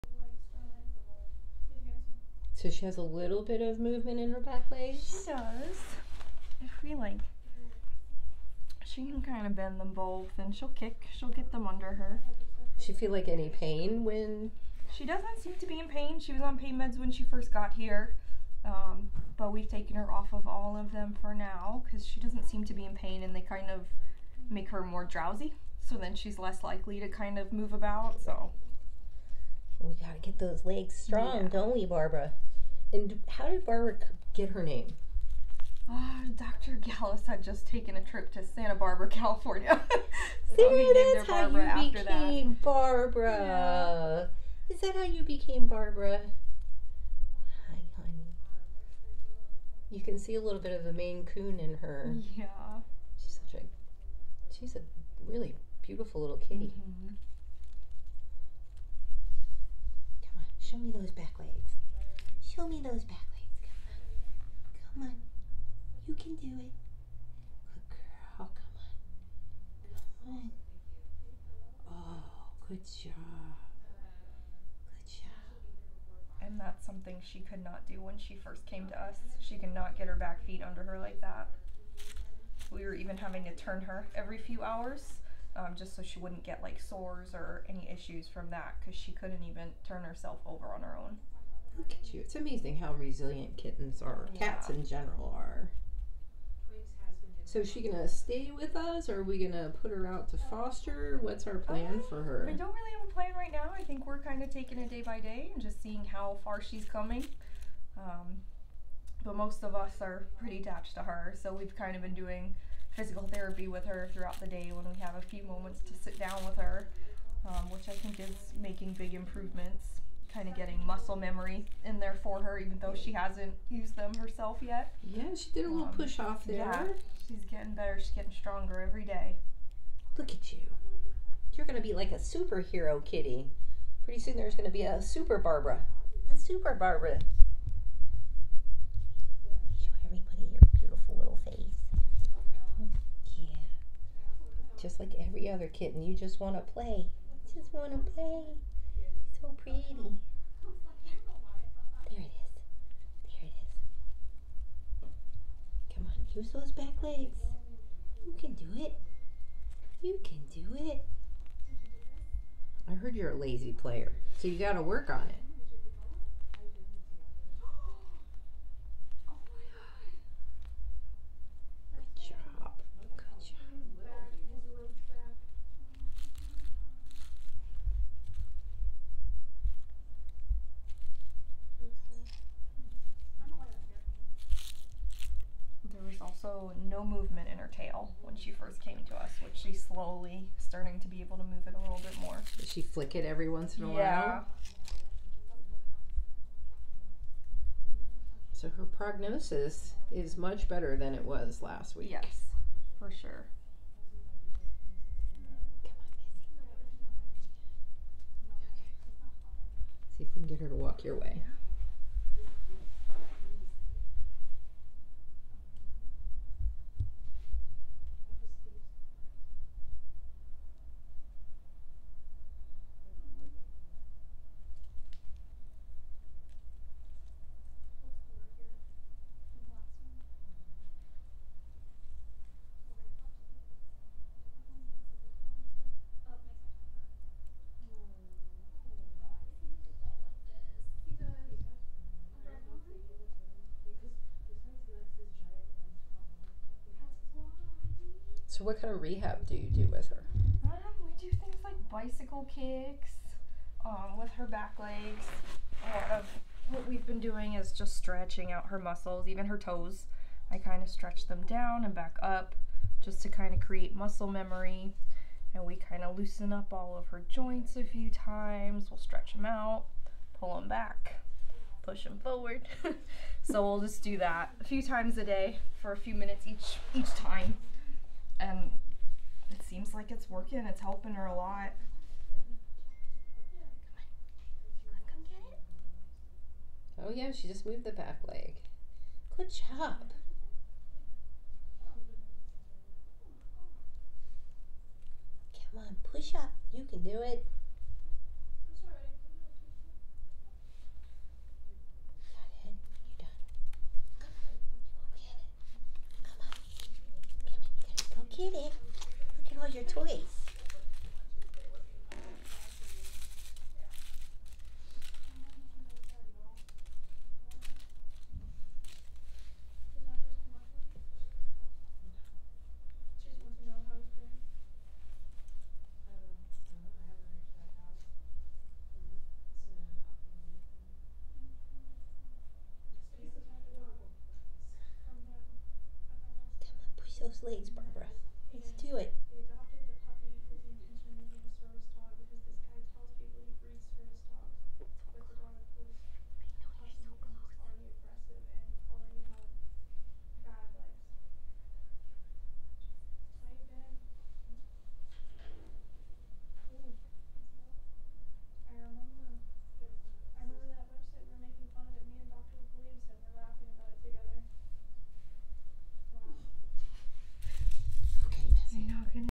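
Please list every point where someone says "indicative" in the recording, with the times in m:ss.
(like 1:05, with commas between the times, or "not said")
not said.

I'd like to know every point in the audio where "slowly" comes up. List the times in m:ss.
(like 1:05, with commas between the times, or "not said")
3:09.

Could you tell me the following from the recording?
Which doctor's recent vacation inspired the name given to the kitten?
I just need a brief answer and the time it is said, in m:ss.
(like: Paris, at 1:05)
Dr. Gallus, at 0:36.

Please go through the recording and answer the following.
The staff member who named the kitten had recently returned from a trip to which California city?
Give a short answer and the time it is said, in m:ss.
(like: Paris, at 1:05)
Santa Barbara, at 0:38.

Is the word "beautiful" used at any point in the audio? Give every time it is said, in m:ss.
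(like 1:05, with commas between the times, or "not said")
0:55, 2:20.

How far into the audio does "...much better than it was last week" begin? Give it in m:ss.
3:20.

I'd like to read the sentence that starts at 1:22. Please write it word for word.
We were even having to turn her every few hours.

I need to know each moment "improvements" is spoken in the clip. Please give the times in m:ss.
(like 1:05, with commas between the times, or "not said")
1:59.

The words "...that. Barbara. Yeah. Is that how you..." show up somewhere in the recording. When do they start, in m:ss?
0:42.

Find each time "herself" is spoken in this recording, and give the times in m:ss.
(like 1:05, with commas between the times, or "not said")
1:30, 2:04.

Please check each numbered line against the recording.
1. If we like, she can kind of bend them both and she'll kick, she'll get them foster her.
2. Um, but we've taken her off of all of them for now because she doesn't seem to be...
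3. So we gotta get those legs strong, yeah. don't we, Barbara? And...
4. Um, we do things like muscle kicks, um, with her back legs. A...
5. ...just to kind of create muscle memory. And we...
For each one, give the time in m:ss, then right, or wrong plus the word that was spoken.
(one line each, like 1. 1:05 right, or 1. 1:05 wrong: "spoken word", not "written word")
1. 0:06 wrong: "under", not "foster"
2. 0:18 right
3. 0:28 right
4. 4:10 wrong: "bicycle", not "muscle"
5. 4:23 right.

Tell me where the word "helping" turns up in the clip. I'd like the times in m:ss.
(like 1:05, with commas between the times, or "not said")
4:40.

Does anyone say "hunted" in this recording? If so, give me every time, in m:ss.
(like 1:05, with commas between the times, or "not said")
not said.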